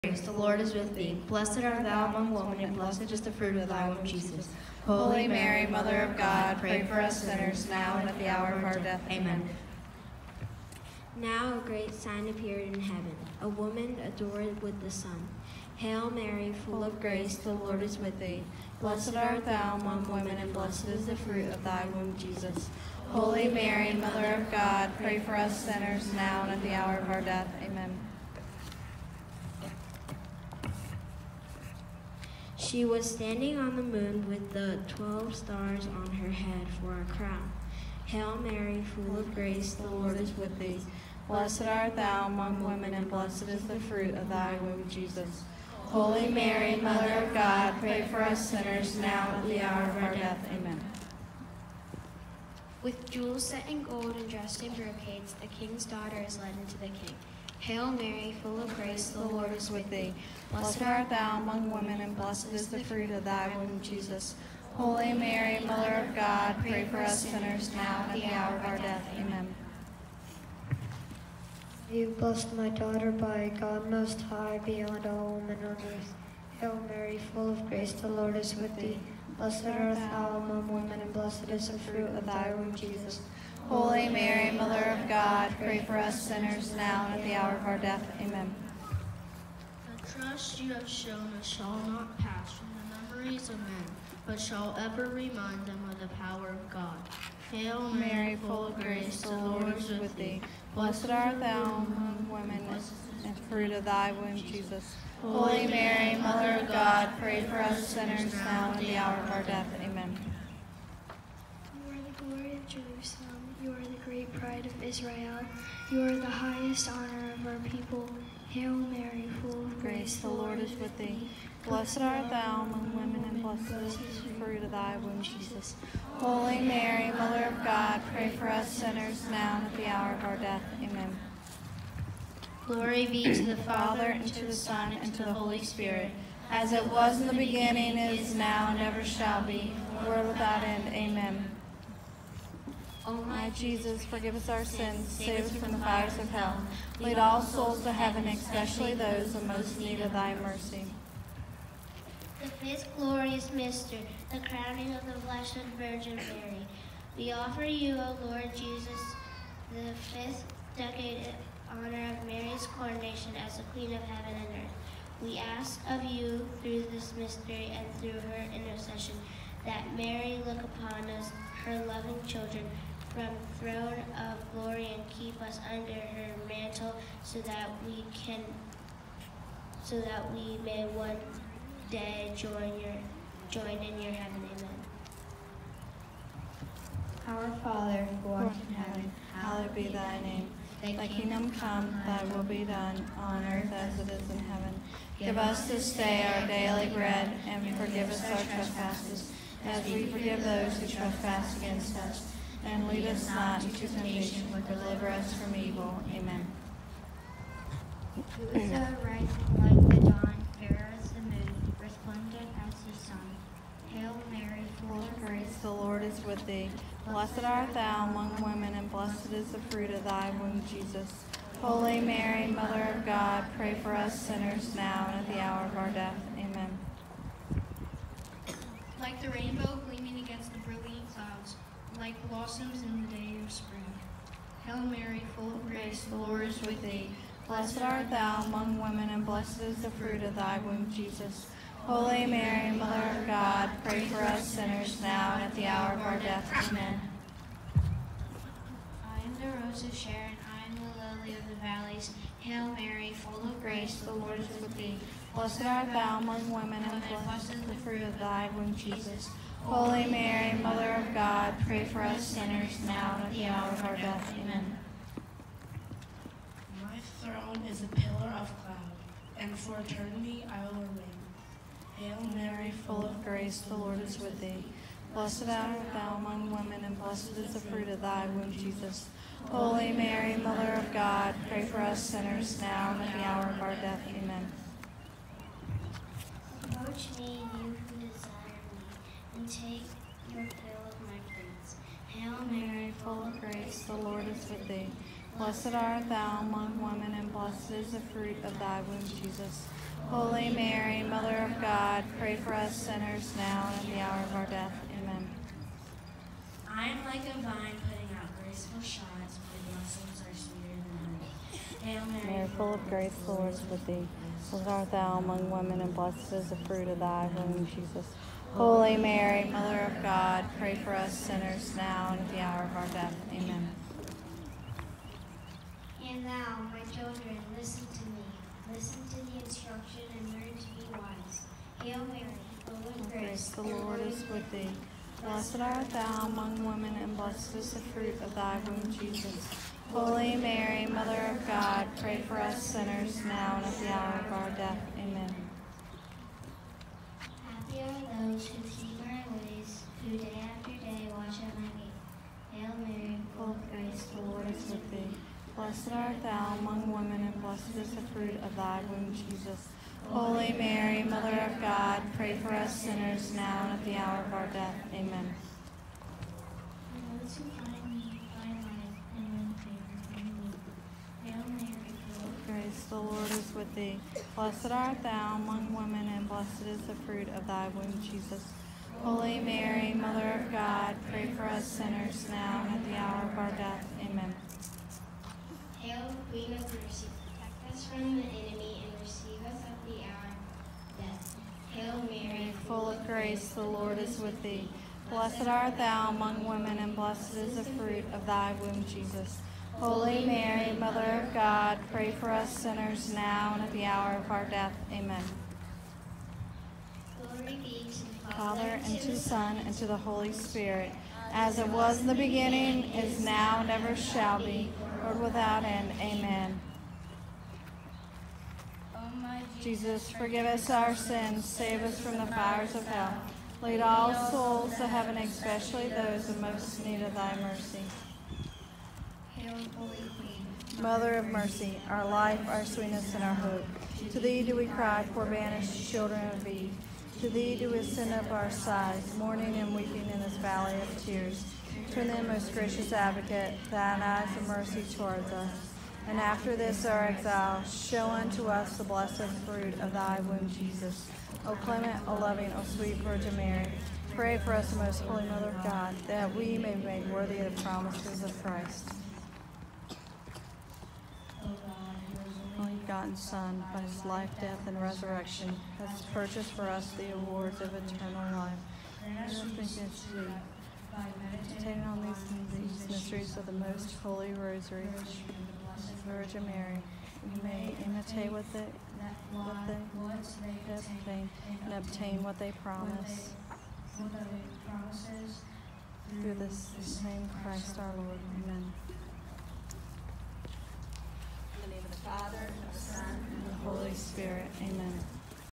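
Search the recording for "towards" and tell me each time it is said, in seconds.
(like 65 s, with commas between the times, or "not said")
444 s.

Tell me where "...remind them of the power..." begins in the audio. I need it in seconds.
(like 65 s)
95 s.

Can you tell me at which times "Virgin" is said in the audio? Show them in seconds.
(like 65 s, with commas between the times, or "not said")
155 s, 452 s, 476 s.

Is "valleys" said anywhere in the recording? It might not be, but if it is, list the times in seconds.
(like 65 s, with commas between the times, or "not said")
251 s, 440 s.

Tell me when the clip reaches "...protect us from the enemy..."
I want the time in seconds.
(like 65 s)
387 s.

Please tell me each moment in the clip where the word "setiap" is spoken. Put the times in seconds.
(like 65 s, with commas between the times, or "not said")
not said.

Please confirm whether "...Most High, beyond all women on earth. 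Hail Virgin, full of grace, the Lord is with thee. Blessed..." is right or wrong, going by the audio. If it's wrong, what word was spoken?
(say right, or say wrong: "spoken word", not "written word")
wrong: "Mary", not "Virgin".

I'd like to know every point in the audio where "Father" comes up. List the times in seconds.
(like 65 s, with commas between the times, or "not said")
133 s, 187 s, 408 s, 492 s.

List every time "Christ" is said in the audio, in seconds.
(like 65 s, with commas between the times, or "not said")
458 s, 487 s.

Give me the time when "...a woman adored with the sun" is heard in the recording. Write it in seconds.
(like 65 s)
13 s.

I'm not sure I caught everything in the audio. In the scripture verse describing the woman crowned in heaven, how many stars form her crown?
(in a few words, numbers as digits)
12.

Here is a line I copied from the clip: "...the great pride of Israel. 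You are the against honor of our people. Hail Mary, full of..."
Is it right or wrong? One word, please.
wrong.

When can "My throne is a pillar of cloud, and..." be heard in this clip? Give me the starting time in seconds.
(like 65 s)
266 s.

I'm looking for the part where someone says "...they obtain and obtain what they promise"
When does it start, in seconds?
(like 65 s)
480 s.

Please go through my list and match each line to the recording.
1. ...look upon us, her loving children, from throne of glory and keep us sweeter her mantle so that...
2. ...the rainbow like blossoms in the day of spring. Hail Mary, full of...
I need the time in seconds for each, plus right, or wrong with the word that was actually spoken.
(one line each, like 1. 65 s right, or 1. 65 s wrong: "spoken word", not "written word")
1. 170 s wrong: "under", not "sweeter"
2. 229 s right.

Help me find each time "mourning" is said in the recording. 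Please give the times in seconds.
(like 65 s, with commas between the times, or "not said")
439 s.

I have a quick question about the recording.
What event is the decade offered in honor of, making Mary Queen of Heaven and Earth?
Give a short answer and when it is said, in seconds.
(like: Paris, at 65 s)
Mary's coronation, at 162 s.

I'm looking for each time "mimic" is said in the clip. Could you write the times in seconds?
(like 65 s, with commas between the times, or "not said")
not said.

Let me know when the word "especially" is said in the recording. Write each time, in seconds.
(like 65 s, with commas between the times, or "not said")
148 s, 425 s.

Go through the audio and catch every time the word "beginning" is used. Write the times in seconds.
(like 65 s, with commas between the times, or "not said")
137 s, 412 s.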